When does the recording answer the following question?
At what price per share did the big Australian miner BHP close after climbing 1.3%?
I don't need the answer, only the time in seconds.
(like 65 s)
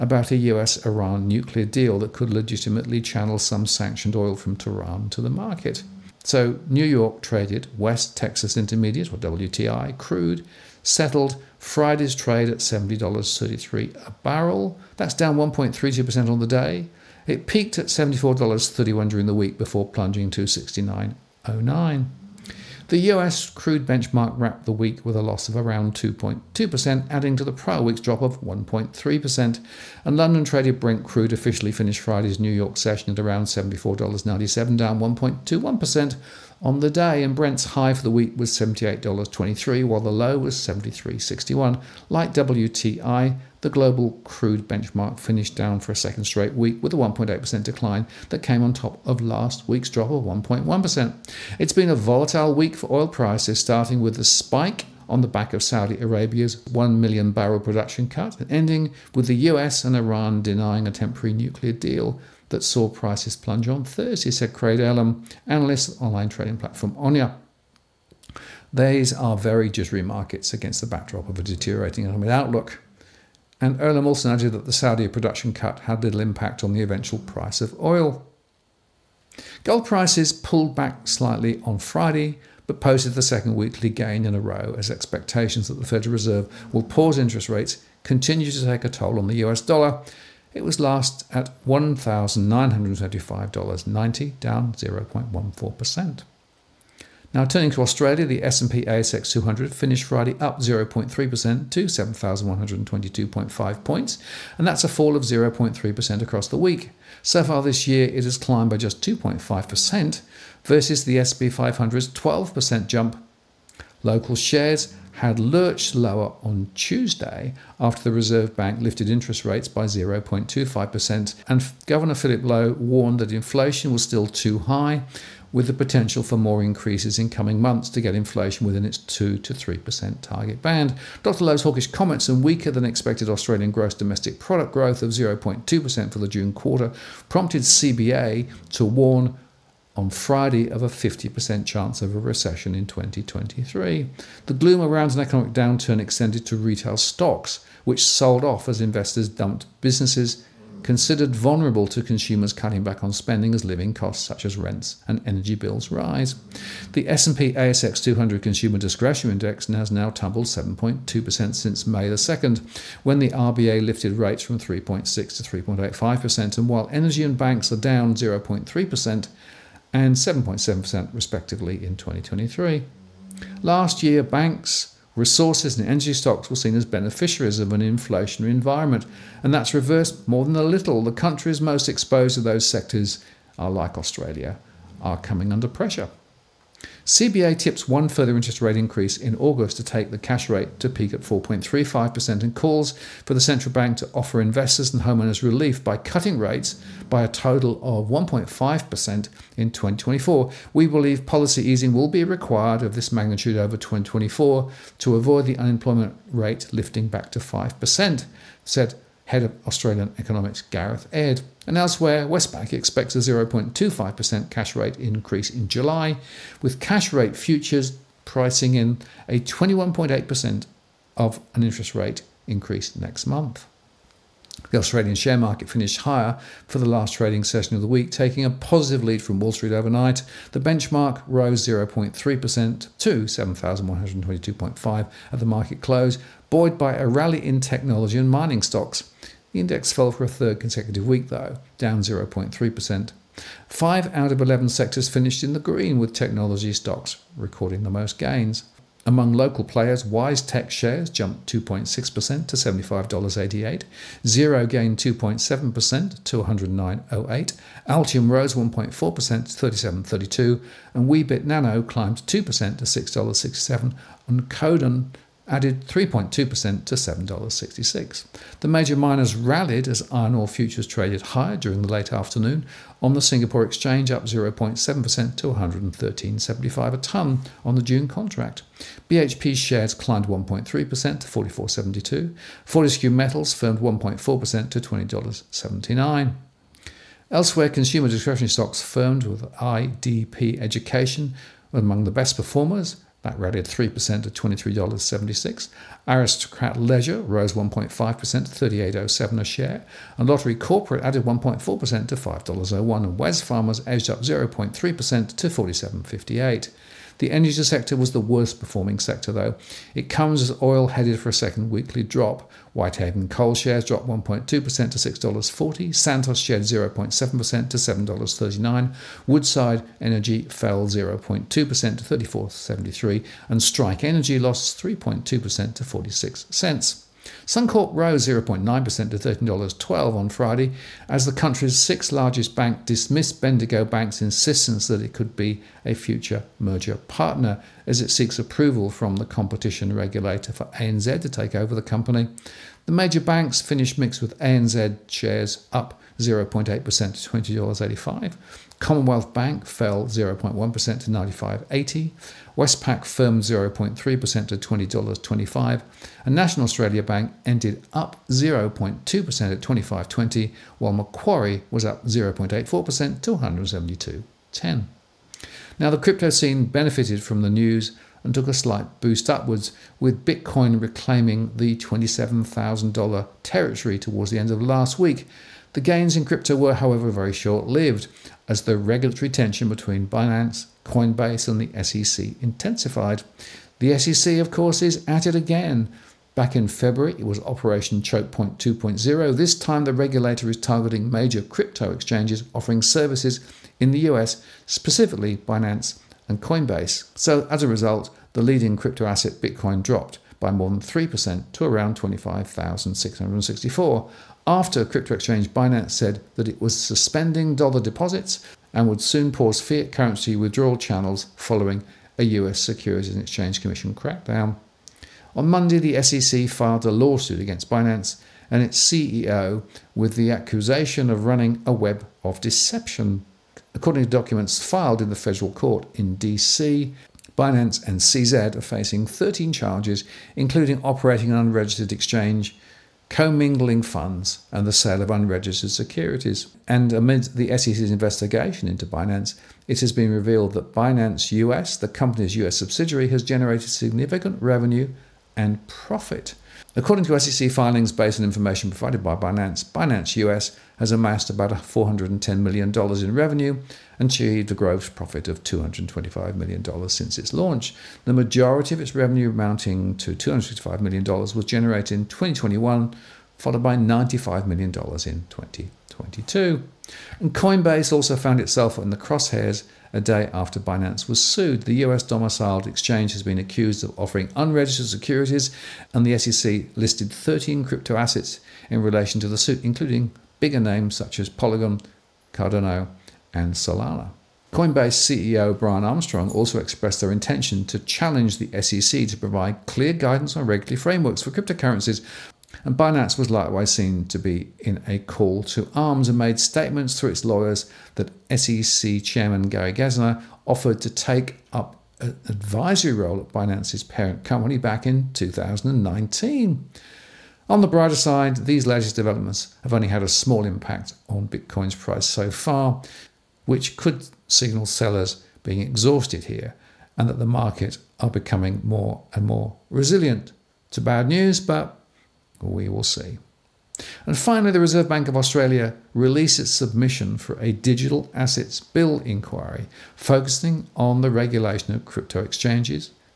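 281 s.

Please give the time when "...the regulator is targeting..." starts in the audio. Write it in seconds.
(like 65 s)
389 s.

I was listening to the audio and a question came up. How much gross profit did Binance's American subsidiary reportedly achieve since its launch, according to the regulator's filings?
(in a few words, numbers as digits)
$225 million.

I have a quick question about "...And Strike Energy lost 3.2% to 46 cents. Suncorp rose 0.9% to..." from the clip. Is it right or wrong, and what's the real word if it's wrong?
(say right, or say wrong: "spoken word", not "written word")
right.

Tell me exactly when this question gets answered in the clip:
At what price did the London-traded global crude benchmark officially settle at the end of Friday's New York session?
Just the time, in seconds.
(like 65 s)
33 s.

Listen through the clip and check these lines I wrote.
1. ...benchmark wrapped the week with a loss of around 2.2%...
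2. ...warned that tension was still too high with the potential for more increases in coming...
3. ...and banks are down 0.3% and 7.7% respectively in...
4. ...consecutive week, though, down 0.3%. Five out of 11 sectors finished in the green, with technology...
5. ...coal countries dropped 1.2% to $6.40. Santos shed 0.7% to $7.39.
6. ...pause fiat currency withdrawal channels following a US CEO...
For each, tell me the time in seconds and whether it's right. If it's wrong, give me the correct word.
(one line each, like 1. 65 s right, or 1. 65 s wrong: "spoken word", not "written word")
1. 23 s right
2. 122 s wrong: "inflation", not "tension"
3. 167 s right
4. 240 s right
5. 313 s wrong: "shares", not "countries"
6. 409 s wrong: "Securities", not "CEO".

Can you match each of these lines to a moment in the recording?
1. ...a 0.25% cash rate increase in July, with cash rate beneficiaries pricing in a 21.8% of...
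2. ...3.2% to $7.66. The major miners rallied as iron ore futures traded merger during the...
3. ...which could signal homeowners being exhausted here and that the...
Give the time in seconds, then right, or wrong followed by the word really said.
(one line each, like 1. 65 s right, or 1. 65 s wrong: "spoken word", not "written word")
1. 213 s wrong: "futures", not "beneficiaries"
2. 265 s wrong: "higher", not "merger"
3. 513 s wrong: "sellers", not "homeowners".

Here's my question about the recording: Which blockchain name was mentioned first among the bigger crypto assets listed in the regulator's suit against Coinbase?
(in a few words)
Polygon.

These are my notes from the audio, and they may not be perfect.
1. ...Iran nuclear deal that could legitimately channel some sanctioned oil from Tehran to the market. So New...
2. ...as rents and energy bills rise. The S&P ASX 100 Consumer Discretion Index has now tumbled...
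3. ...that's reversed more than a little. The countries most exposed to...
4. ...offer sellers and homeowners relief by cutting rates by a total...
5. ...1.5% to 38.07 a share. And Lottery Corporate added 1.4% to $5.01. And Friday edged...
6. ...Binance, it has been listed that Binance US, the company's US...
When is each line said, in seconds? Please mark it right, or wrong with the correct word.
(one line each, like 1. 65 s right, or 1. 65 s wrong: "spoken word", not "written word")
1. 0 s right
2. 154 s wrong: "200", not "100"
3. 179 s right
4. 194 s wrong: "investors", not "sellers"
5. 297 s wrong: "Wesfarmers", not "Friday"
6. 438 s wrong: "revealed", not "listed".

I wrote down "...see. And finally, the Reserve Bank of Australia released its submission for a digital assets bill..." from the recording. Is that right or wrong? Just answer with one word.
right.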